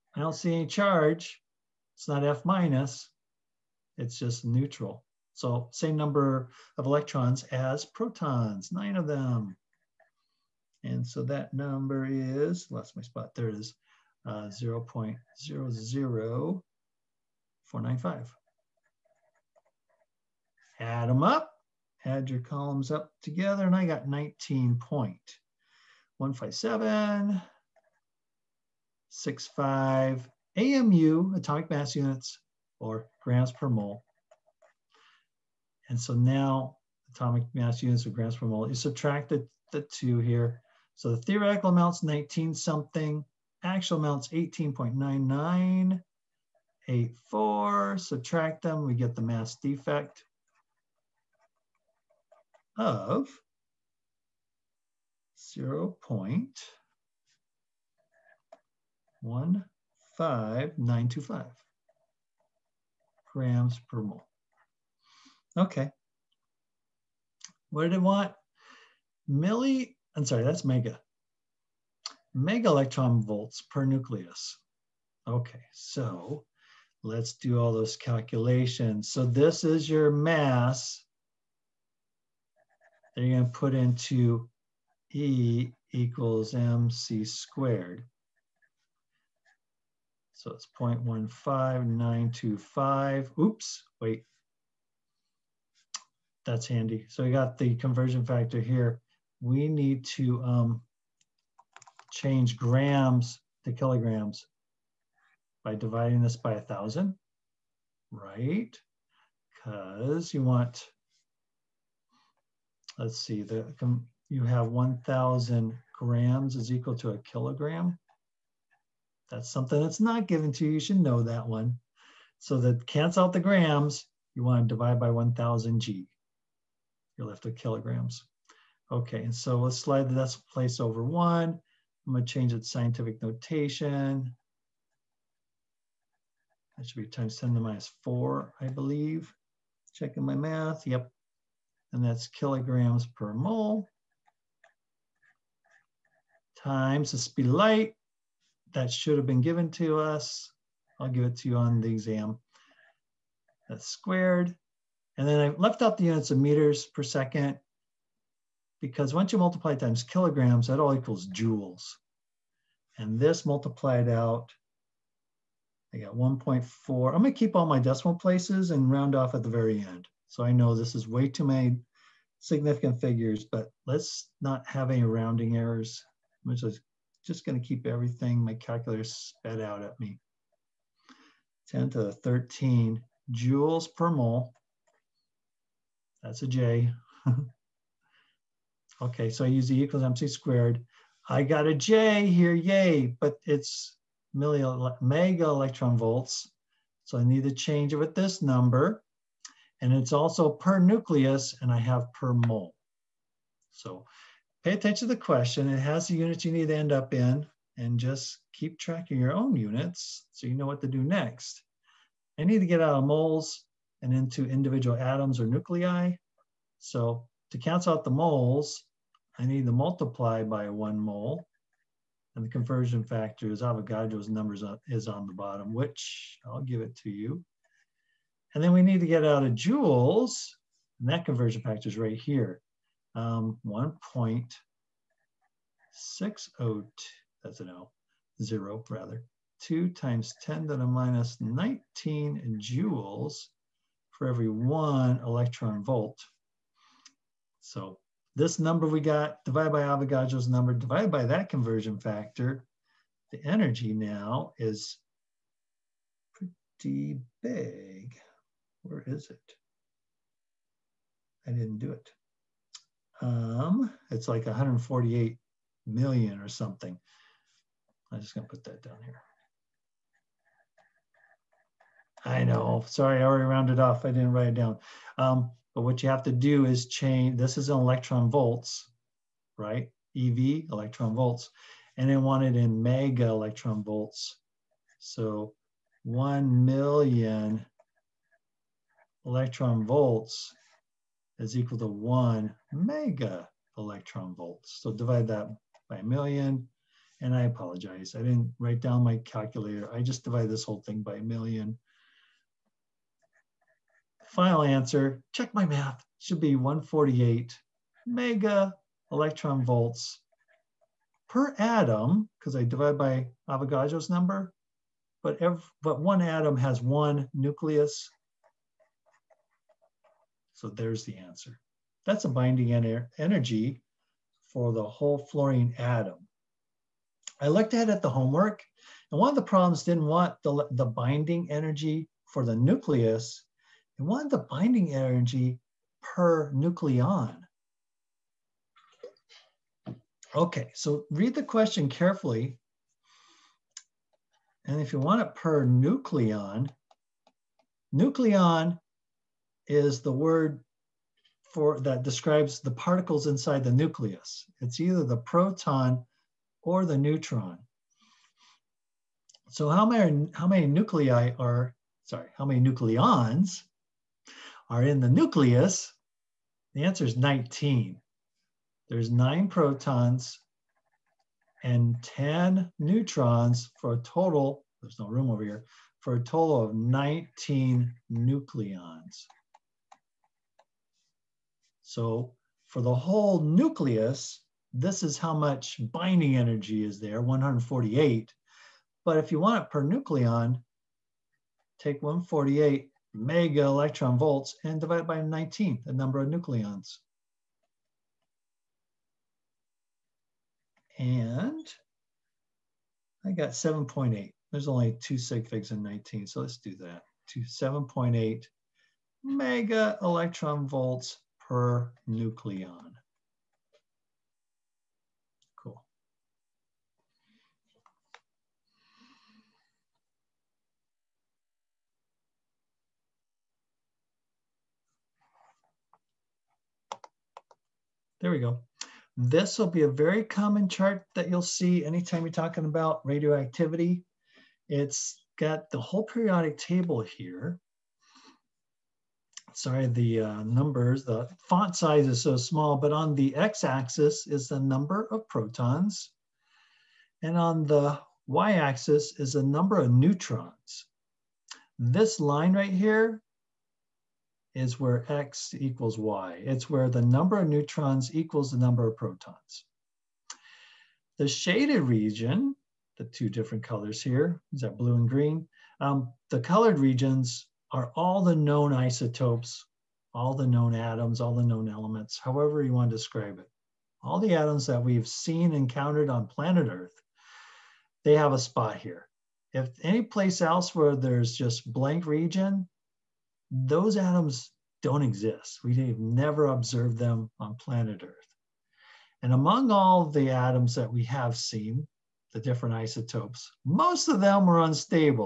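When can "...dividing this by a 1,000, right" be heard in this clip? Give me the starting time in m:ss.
1:45.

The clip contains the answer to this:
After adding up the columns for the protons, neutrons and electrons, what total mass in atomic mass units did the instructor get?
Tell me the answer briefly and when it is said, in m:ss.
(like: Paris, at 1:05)
19.15765, at 0:24.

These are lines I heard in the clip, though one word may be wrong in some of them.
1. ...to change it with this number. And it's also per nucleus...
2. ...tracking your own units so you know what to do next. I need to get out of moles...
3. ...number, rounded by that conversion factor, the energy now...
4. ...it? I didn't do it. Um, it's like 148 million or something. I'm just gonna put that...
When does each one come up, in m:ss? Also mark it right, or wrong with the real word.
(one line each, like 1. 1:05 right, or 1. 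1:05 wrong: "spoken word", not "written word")
1. 3:17 right
2. 3:28 right
3. 4:10 wrong: "divided", not "rounded"
4. 4:19 right.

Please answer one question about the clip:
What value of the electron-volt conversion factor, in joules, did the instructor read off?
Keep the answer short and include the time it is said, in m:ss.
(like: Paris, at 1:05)
1.6022 times 10 to the -19, at 3:53.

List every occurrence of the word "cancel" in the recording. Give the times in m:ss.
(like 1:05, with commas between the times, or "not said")
2:02, 3:37.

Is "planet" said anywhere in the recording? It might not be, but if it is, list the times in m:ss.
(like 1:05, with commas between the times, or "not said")
7:56, 8:07.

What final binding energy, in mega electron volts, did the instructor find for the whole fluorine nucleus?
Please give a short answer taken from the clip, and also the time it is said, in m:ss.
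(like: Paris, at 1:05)
148, at 5:06.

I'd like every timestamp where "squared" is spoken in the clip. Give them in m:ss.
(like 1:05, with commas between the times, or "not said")
1:27, 2:33, 3:10.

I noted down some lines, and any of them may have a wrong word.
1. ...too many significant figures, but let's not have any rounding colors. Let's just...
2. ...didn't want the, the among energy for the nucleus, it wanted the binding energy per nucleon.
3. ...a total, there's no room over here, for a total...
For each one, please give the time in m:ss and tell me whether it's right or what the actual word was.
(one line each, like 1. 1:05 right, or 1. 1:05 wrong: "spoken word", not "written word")
1. 2:51 wrong: "errors", not "colors"
2. 5:29 wrong: "binding", not "among"
3. 6:13 right.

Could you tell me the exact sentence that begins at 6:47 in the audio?
To 7.8 mega electron volts per nucleon.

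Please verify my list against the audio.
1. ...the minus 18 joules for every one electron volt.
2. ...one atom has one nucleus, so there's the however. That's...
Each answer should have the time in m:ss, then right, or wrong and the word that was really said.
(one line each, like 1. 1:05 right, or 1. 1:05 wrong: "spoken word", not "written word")
1. 4:00 wrong: "19", not "18"
2. 5:16 wrong: "answer", not "however".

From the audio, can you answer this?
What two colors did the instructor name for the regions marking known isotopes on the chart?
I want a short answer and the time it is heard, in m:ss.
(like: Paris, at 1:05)
Blue and green, at 7:44.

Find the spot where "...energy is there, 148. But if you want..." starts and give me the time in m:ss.
6:26.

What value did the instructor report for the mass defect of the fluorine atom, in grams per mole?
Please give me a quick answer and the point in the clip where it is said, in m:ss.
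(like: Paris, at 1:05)
0.15925, at 0:55.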